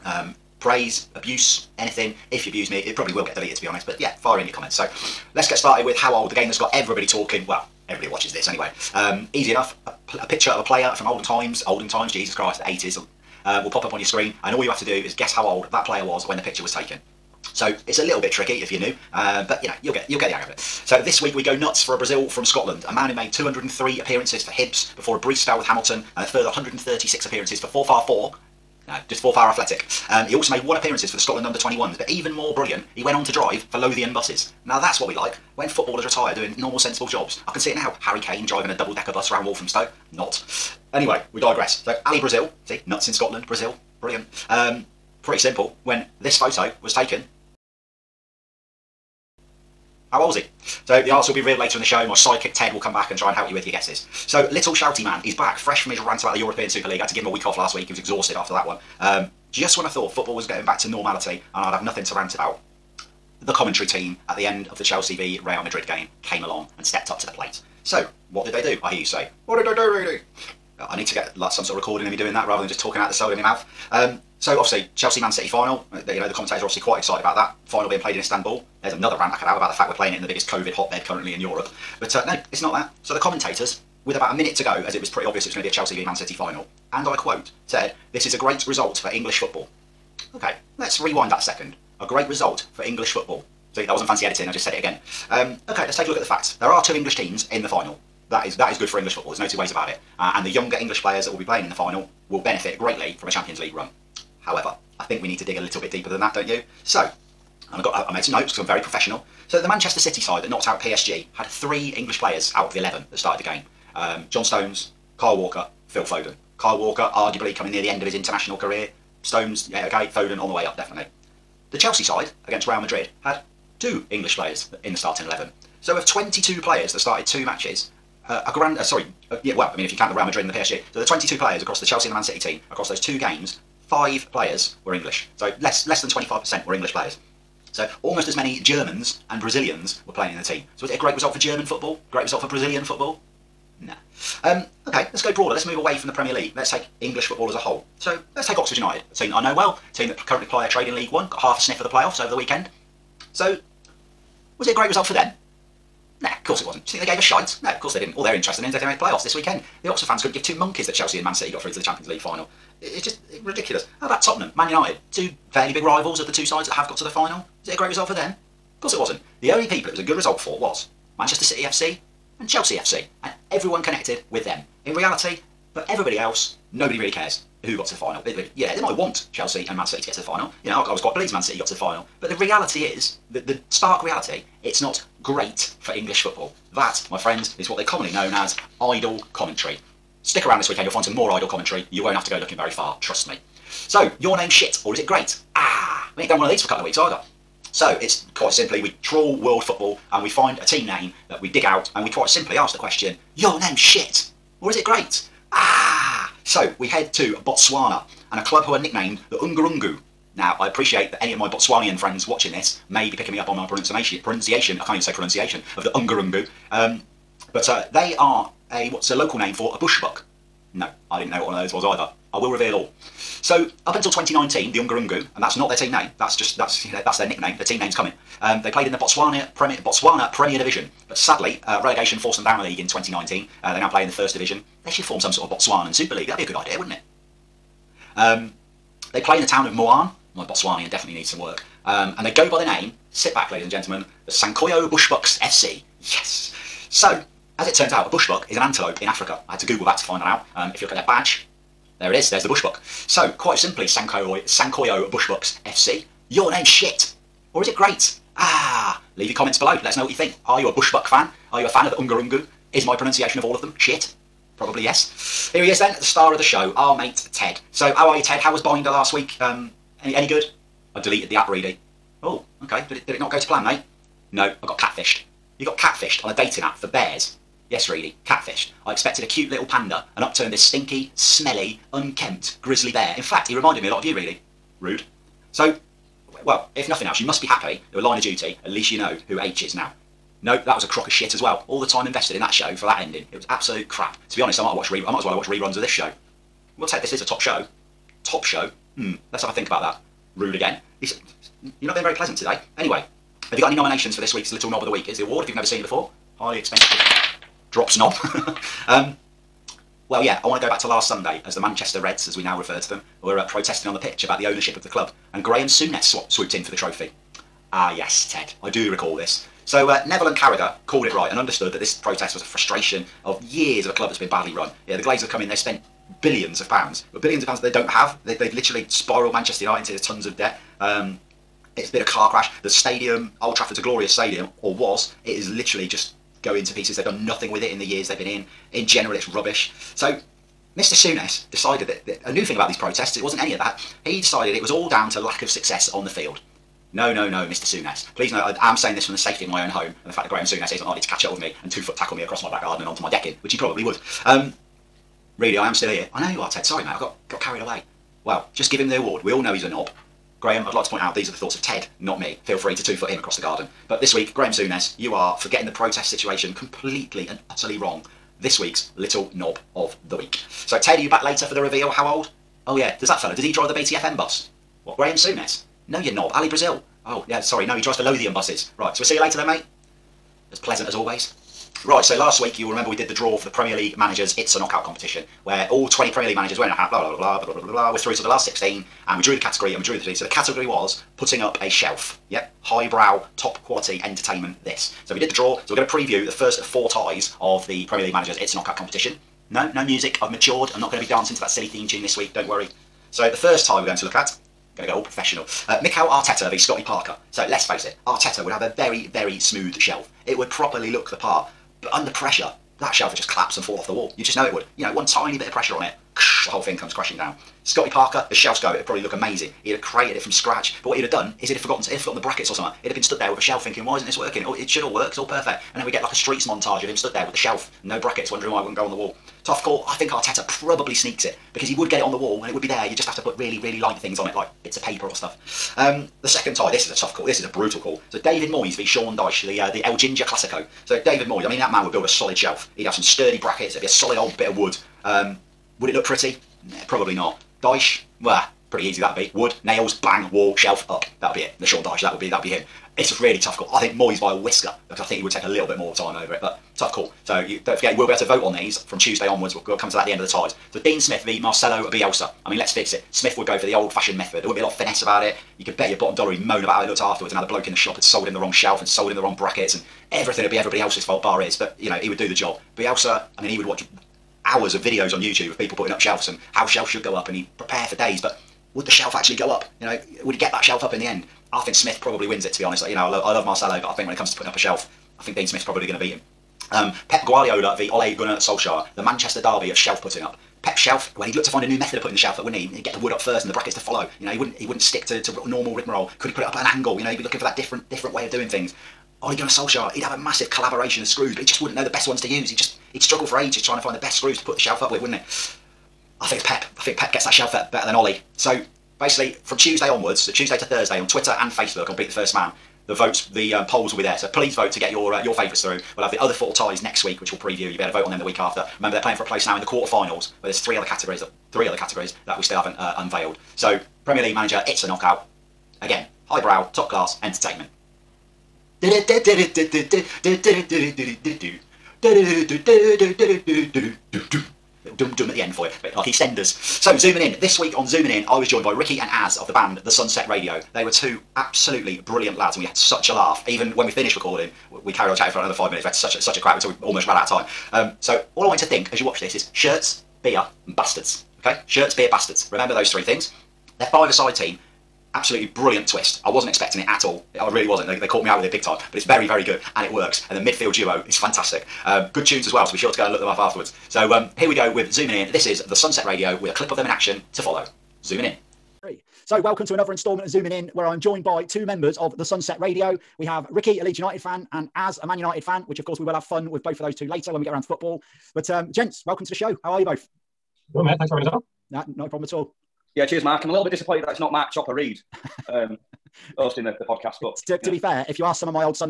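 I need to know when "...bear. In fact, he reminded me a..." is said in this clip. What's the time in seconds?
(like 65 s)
282 s.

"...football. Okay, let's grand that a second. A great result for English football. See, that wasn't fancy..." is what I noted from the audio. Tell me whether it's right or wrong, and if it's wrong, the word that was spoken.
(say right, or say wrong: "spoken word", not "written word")
wrong: "rewind", not "grand".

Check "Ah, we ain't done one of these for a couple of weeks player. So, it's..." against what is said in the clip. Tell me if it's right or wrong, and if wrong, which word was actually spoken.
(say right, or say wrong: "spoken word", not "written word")
wrong: "either", not "player".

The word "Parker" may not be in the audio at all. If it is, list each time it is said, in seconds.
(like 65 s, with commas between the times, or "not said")
406 s, 417 s.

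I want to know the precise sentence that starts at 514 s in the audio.
So please vote to get your uh, your favourites through.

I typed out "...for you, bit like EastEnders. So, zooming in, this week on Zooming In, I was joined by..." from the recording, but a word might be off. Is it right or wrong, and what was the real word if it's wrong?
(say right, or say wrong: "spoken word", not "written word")
right.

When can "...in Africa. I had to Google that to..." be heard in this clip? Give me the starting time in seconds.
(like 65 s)
249 s.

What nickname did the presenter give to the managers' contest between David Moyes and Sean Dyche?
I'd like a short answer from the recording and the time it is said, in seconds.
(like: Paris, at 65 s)
El Ginger Classico, at 439 s.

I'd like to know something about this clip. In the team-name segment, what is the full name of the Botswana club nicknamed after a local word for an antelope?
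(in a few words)
Sankoyo Bushbucks FC.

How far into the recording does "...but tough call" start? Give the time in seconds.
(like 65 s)
456 s.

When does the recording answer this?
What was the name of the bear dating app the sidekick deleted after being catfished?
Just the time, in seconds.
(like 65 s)
268 s.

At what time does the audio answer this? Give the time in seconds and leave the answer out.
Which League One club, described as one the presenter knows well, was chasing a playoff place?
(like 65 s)
148 s.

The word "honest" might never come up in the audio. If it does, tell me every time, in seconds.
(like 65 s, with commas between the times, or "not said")
3 s, 294 s, 482 s.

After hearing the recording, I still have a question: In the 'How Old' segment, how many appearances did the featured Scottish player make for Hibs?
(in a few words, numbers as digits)
203.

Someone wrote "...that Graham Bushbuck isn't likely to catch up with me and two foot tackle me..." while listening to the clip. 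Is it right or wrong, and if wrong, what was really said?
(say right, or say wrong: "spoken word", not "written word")
wrong: "Souness", not "Bushbuck".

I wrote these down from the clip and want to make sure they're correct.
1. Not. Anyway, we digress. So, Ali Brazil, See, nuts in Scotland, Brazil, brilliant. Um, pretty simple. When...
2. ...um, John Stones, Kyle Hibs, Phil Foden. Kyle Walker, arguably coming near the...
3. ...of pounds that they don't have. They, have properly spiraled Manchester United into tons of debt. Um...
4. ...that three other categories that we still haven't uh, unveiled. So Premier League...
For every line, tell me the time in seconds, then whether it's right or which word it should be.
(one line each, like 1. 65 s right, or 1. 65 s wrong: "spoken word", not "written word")
1. 40 s right
2. 113 s wrong: "Walker", not "Hibs"
3. 327 s wrong: "literally", not "properly"
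4. 521 s right.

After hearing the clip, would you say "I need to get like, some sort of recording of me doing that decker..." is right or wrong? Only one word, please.
wrong.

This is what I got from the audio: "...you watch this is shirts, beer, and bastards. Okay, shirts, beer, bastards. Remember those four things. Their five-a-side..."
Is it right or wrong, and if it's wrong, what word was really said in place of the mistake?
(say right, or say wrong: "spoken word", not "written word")
wrong: "three", not "four".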